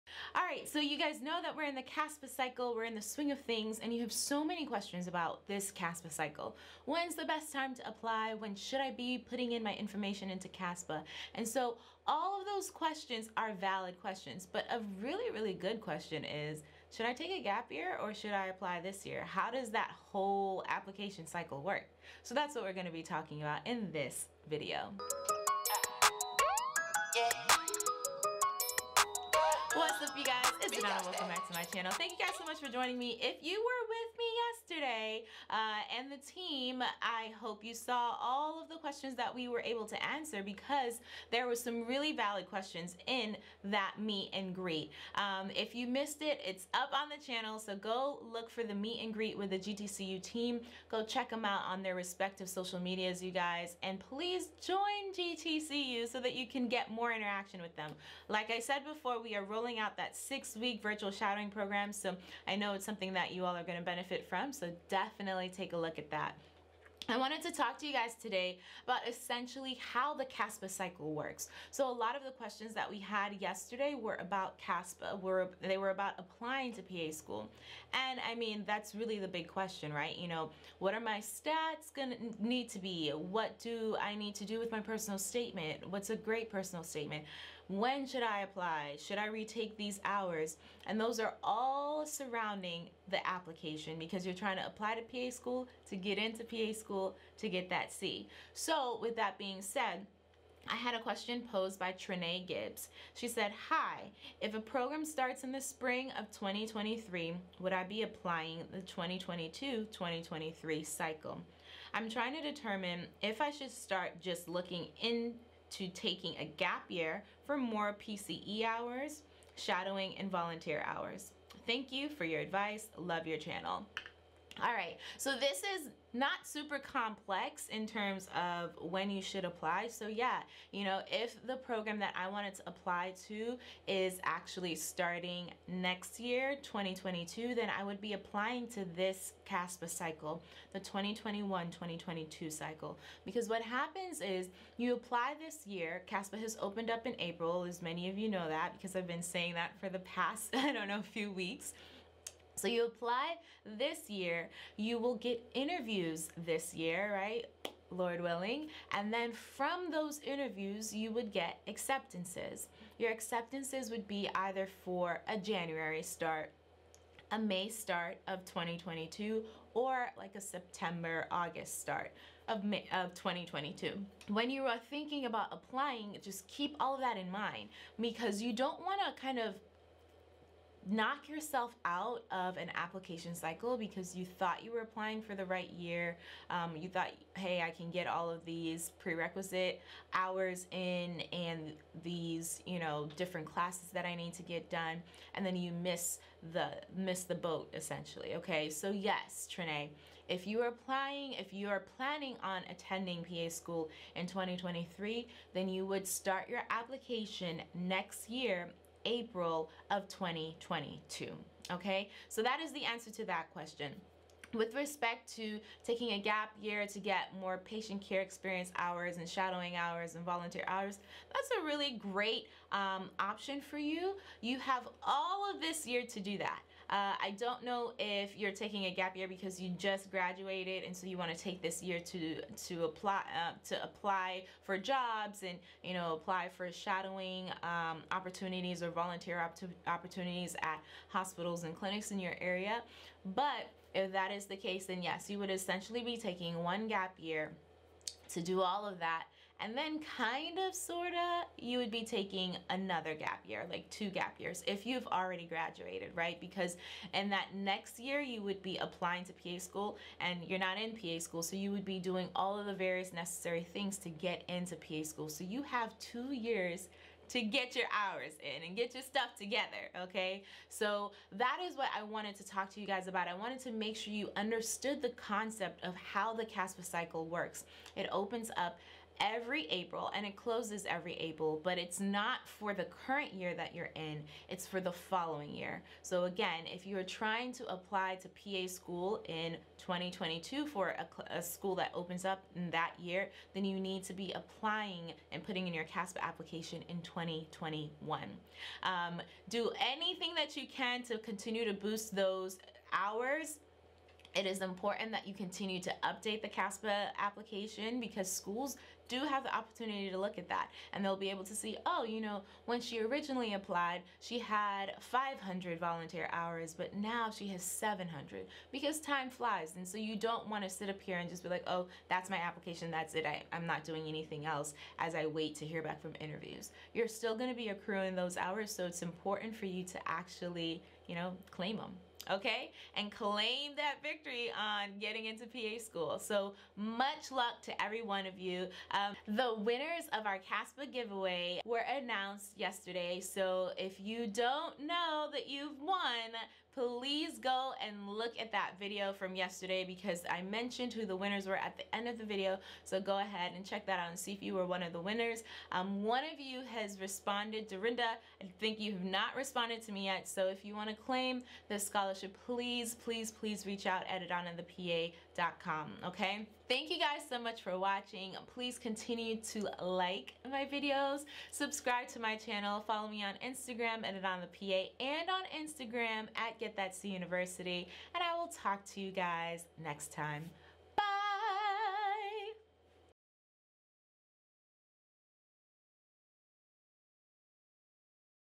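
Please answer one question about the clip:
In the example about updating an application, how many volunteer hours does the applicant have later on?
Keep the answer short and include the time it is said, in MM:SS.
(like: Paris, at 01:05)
700, at 05:17.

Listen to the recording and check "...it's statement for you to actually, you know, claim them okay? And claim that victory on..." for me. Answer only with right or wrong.
wrong.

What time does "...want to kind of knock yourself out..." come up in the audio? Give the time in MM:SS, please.
02:58.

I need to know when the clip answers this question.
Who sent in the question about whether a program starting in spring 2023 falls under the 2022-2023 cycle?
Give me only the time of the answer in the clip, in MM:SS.
01:41.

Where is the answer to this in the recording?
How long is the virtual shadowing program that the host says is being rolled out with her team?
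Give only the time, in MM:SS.
01:00.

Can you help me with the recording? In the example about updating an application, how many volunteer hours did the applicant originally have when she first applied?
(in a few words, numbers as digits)
500.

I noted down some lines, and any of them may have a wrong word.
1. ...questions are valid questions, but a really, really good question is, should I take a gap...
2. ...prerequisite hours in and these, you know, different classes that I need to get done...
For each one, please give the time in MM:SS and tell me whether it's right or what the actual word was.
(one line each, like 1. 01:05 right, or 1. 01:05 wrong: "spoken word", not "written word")
1. 00:12 right
2. 03:08 right.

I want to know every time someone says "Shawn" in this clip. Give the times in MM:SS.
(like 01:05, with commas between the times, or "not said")
not said.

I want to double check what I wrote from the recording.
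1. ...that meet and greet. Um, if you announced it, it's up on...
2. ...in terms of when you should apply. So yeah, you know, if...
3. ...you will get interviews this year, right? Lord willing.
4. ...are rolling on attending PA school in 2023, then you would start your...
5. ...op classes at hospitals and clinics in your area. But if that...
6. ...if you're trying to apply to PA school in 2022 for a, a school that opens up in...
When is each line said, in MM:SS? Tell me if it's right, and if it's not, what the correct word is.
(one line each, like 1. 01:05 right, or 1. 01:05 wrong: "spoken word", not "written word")
1. 00:43 wrong: "missed", not "announced"
2. 02:07 right
3. 02:34 right
4. 03:21 wrong: "planning", not "rolling"
5. 03:59 wrong: "opportunities", not "classes"
6. 04:46 right.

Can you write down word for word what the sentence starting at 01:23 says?
What do I need to do with my personal statement?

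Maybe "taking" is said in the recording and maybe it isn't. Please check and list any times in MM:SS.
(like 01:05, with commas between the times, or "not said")
01:55, 03:35, 03:48, 04:06, 04:12.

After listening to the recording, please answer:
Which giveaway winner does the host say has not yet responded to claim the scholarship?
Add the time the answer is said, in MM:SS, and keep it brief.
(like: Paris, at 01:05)
Dorinda, at 05:57.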